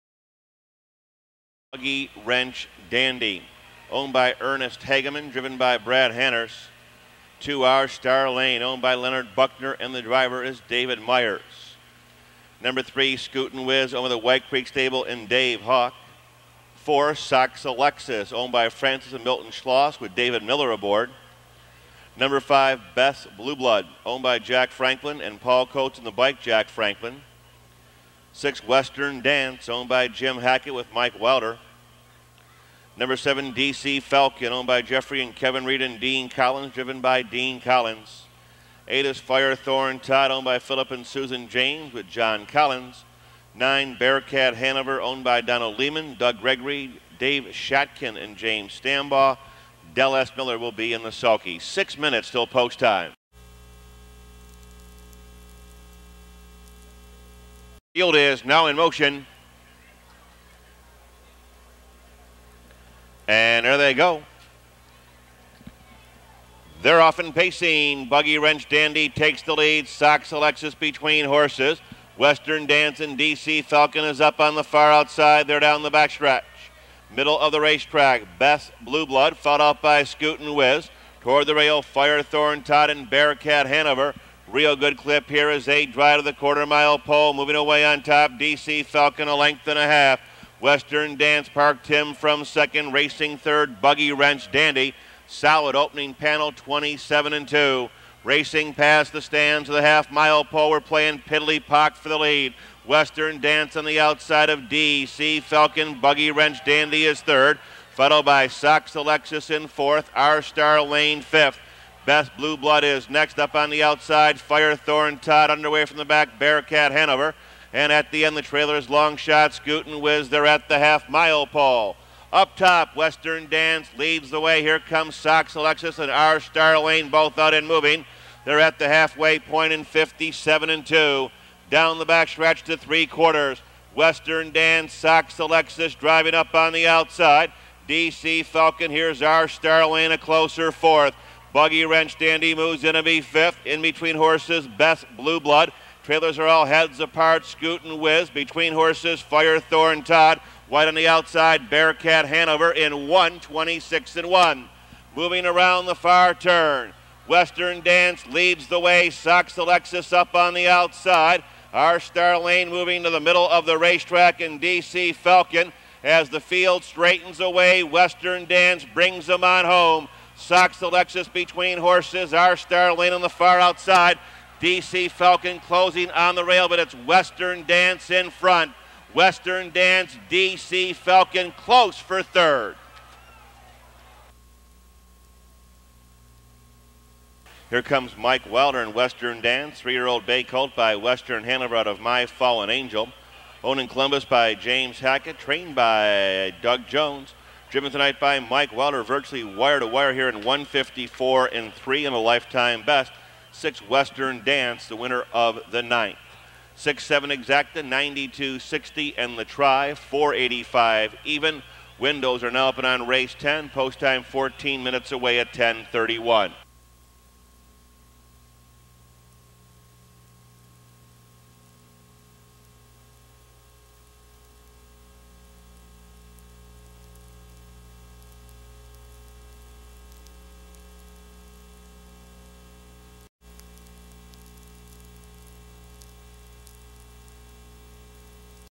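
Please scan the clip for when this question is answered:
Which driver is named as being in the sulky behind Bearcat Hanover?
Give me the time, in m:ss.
0:49.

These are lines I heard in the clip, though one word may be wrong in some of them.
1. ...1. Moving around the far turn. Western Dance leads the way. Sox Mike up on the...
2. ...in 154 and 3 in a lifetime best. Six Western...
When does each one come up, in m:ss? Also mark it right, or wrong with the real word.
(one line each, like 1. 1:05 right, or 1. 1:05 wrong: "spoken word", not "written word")
1. 2:34 wrong: "Alexis", not "Mike"
2. 3:20 right.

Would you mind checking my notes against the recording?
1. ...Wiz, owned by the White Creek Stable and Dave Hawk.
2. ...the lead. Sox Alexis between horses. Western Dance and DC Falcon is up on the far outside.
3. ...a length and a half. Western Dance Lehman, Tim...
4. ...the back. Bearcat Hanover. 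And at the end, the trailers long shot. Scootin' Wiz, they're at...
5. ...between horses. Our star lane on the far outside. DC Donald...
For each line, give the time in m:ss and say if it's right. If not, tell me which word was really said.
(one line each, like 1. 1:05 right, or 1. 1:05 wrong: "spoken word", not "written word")
1. 0:13 right
2. 1:09 right
3. 1:29 wrong: "Park", not "Lehman"
4. 1:55 right
5. 2:51 wrong: "Falcon", not "Donald".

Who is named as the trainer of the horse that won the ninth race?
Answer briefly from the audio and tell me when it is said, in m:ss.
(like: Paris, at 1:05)
Doug Jones, at 3:16.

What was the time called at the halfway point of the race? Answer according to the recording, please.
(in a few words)
57 and 2.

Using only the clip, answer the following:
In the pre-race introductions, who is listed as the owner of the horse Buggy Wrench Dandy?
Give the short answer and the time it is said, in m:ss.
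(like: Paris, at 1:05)
Ernest Hageman, at 0:04.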